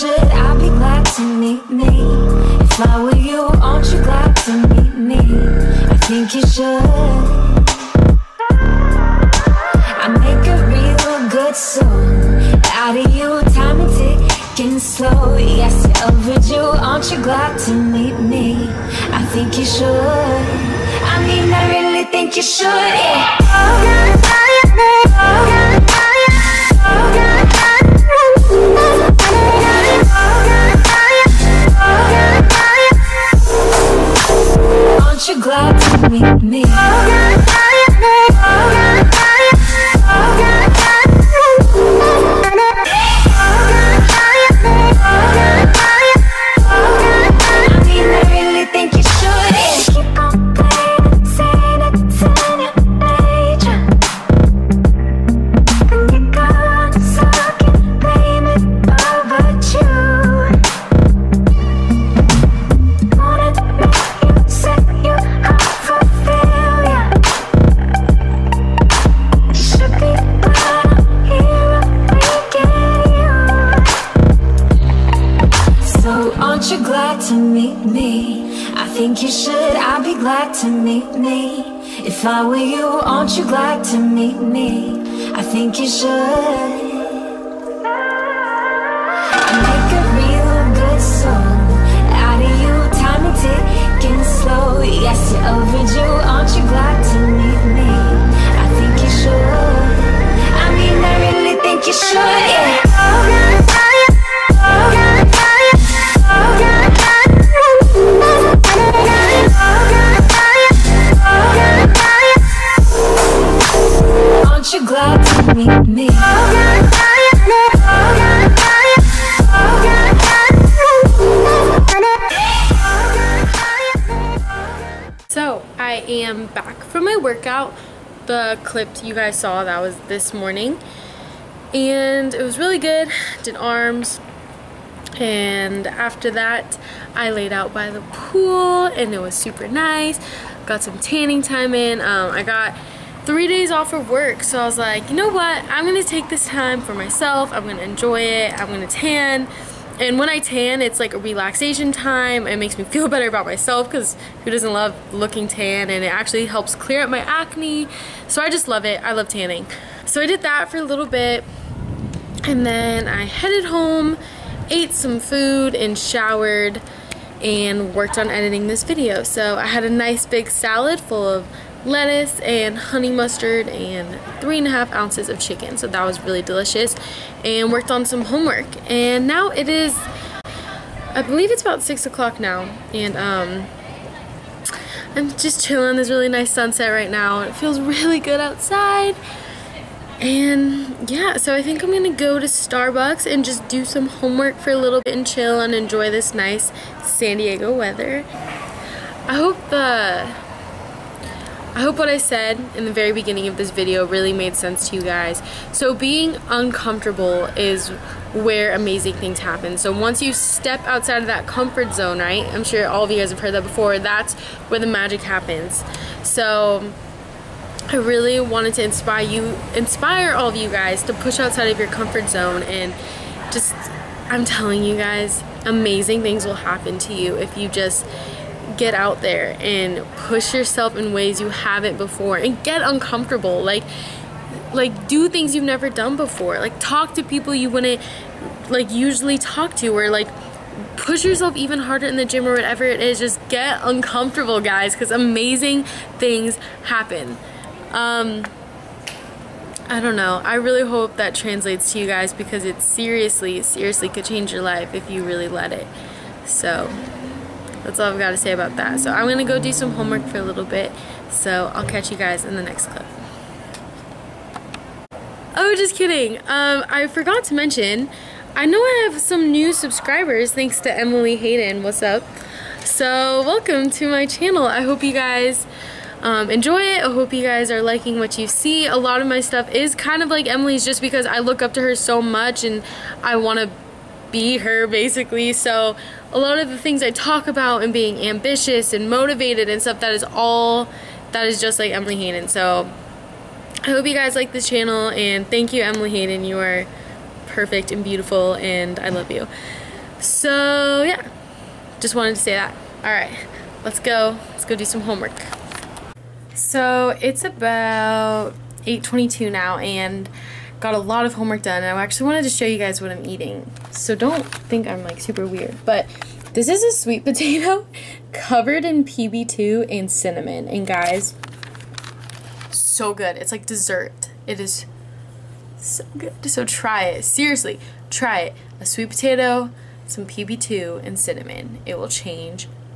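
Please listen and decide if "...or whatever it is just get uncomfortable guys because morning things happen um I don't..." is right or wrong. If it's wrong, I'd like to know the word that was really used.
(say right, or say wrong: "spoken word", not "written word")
wrong: "amazing", not "morning".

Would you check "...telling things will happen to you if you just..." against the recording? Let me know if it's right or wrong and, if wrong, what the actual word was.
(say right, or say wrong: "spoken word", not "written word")
wrong: "amazing", not "telling".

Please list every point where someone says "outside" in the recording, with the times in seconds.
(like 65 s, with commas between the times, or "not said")
188 s, 210 s, 221 s.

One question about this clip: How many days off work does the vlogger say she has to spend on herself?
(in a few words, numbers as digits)
3.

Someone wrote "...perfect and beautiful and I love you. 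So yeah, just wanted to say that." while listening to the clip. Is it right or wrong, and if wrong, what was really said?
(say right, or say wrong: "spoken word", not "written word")
right.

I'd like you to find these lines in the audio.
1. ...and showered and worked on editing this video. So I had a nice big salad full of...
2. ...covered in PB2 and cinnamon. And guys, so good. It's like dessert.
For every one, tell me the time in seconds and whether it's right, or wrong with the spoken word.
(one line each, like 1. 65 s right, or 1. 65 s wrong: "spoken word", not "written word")
1. 165 s right
2. 318 s right.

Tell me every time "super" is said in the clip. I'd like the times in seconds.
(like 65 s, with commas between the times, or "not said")
139 s, 315 s.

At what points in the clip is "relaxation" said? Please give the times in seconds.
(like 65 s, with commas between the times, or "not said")
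151 s.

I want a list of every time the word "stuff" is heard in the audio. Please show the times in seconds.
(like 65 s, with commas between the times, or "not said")
279 s, 289 s.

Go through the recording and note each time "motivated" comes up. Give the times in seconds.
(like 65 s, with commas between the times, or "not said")
289 s.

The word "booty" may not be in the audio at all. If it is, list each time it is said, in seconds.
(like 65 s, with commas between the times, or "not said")
not said.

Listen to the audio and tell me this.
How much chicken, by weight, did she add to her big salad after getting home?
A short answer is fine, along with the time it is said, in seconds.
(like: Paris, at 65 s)
3.5 ounces, at 174 s.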